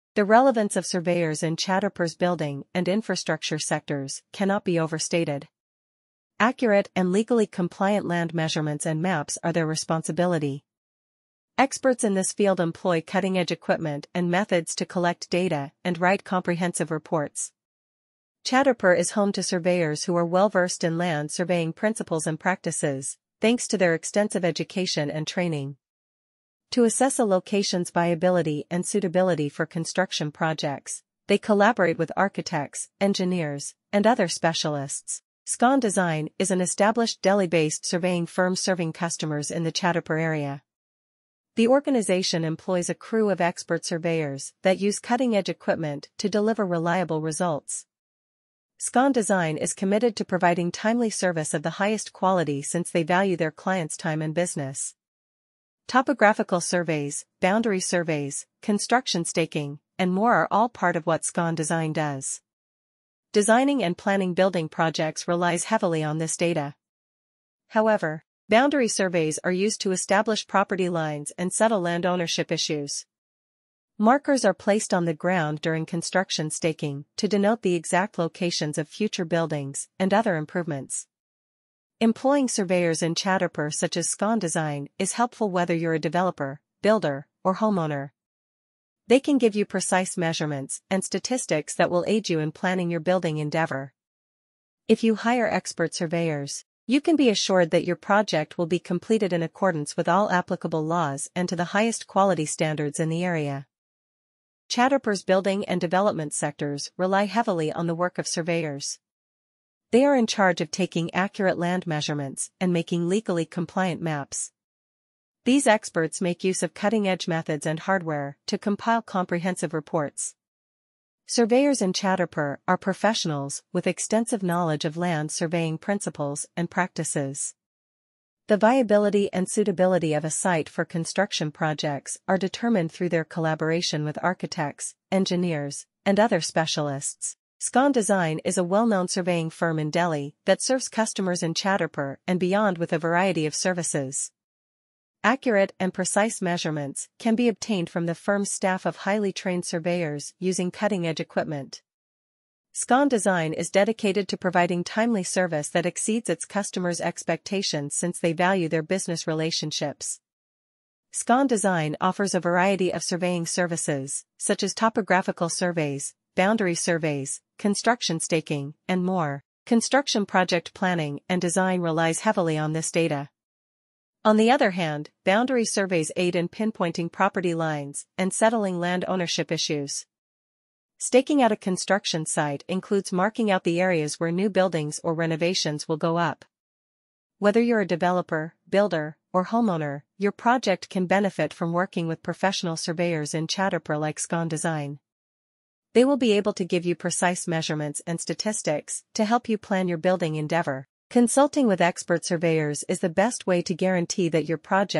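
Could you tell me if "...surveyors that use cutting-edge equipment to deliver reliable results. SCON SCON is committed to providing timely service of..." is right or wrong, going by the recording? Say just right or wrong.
wrong.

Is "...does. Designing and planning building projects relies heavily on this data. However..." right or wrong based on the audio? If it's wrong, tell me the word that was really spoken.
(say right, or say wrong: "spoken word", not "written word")
right.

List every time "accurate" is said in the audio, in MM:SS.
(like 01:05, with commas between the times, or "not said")
00:06, 01:51, 02:25.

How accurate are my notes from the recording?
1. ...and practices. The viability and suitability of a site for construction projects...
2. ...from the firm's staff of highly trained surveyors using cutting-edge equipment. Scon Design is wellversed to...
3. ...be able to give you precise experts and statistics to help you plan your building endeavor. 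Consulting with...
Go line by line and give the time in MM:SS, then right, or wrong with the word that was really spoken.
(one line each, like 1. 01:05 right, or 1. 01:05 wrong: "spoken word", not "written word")
1. 02:06 right
2. 02:27 wrong: "dedicated", not "wellversed"
3. 03:16 wrong: "measurements", not "experts".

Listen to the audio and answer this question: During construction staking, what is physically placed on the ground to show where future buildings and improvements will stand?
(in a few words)
Markers.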